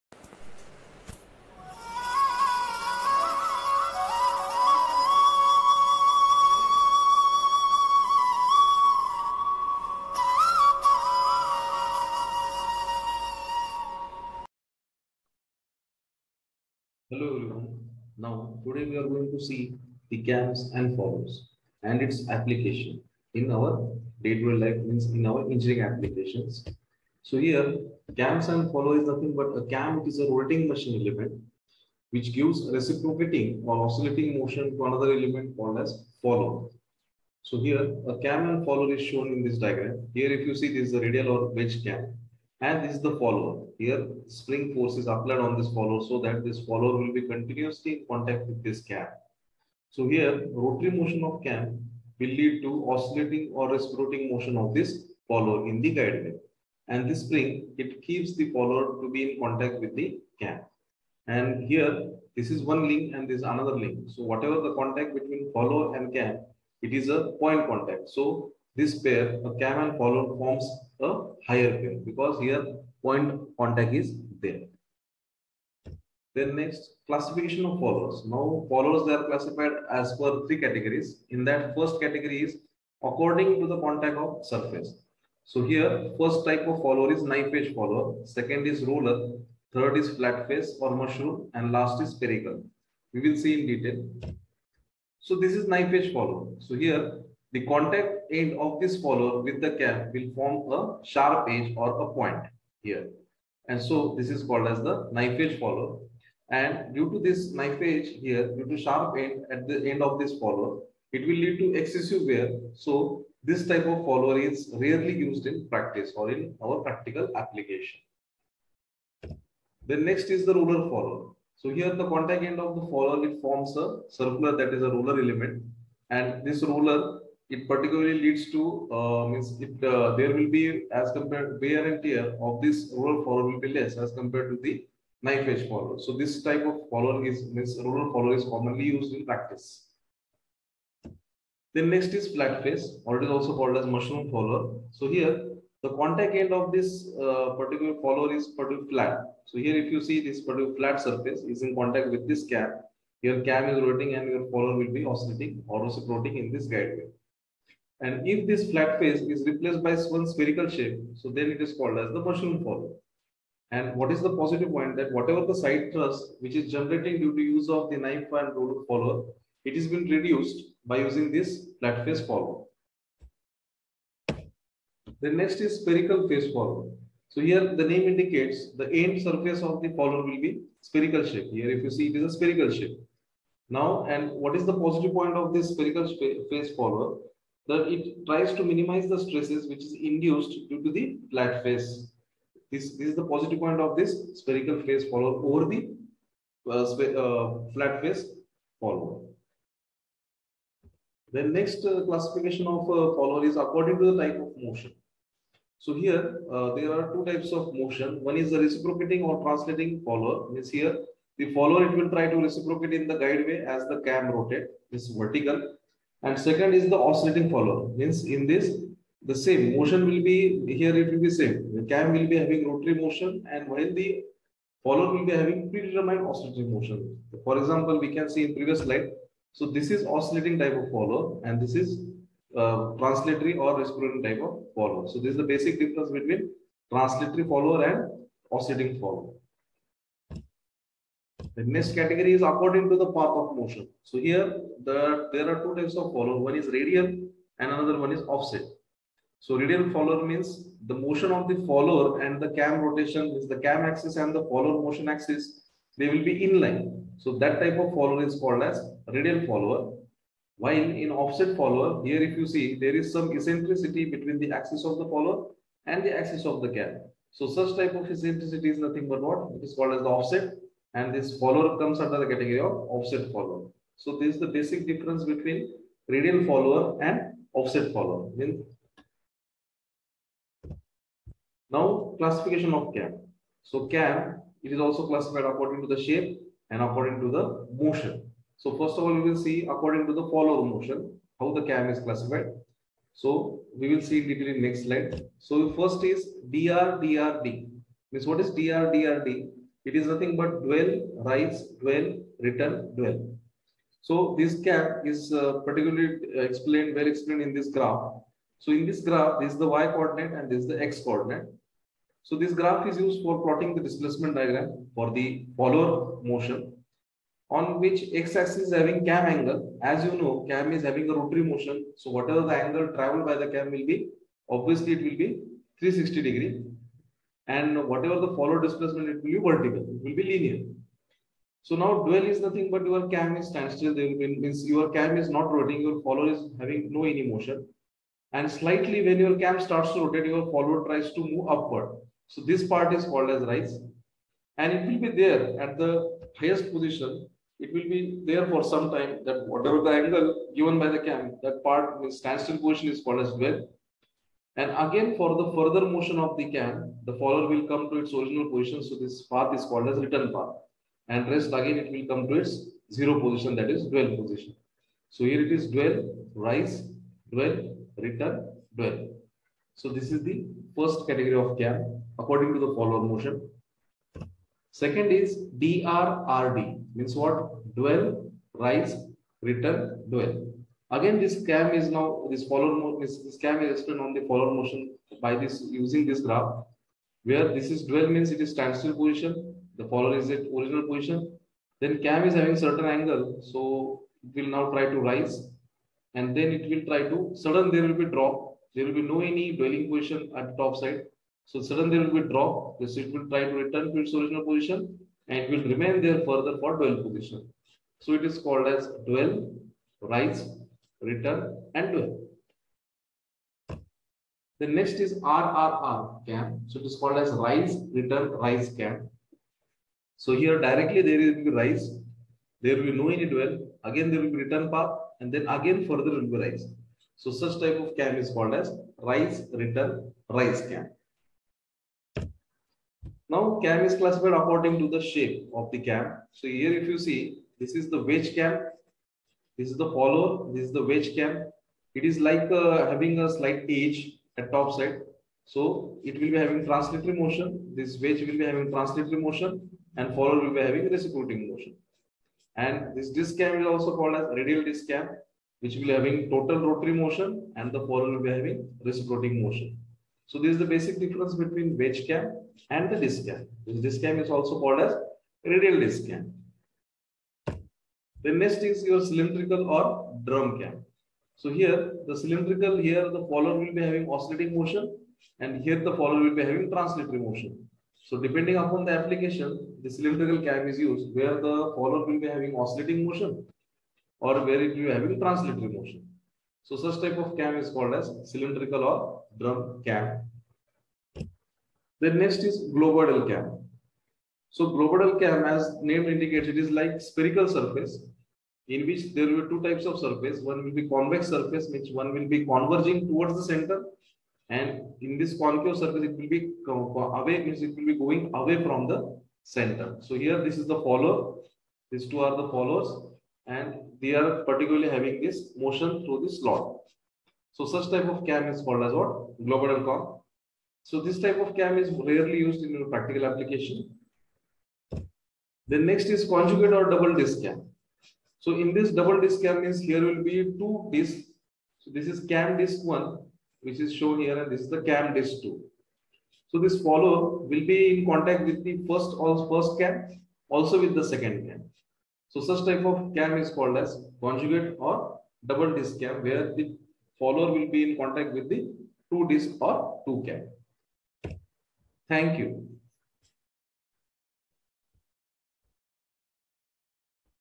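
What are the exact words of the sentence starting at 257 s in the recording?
So that type of follower is called as radial follower.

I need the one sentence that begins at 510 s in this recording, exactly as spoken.
So here, this is the follower.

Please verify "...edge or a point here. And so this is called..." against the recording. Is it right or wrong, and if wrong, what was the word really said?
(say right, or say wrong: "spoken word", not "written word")
right.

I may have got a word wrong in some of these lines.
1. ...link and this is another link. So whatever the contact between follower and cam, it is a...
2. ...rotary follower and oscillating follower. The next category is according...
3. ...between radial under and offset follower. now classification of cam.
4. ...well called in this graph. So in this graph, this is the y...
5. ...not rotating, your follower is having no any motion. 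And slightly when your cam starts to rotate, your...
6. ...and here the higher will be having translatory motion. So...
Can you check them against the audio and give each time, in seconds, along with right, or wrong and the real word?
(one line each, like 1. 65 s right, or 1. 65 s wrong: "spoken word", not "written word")
1. 62 s right
2. 236 s wrong: "translatory", not "rotary"
3. 275 s wrong: "follower", not "under"
4. 306 s wrong: "explained", not "called"
5. 335 s right
6. 475 s wrong: "follower", not "higher".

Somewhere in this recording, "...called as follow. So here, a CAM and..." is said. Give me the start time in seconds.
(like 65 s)
35 s.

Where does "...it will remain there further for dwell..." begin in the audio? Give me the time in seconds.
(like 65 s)
405 s.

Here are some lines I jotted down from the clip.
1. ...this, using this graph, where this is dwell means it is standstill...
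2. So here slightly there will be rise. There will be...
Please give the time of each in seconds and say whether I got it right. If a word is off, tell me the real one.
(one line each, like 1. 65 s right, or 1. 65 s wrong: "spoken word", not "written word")
1. 385 s right
2. 420 s wrong: "directly", not "slightly".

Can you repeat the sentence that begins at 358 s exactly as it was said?
So this path is called as return path.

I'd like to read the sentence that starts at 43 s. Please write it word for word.
Here, spring force is applied on this follower so that this follower will be continuously in contact with this cam.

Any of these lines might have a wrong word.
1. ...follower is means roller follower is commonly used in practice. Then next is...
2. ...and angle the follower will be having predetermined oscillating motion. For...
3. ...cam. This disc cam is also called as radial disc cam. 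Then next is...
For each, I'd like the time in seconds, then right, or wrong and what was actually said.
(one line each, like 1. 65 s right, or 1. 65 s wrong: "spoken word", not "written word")
1. 136 s right
2. 223 s wrong: "while", not "angle"
3. 463 s right.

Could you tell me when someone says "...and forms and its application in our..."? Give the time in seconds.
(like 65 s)
20 s.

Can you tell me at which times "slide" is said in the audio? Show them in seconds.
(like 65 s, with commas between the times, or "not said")
228 s, 294 s.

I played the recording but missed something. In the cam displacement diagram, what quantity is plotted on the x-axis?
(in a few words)
Cam angle.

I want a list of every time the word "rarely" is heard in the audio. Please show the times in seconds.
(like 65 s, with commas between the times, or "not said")
114 s, 521 s.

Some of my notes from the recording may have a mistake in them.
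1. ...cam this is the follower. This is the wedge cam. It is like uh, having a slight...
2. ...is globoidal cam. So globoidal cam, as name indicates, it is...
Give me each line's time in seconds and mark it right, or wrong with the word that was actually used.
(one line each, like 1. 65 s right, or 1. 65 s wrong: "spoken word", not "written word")
1. 438 s right
2. 492 s right.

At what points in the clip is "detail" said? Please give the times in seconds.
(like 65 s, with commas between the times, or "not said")
93 s, 294 s.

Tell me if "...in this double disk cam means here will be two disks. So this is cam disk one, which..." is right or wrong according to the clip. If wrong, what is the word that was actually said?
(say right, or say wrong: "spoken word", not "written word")
right.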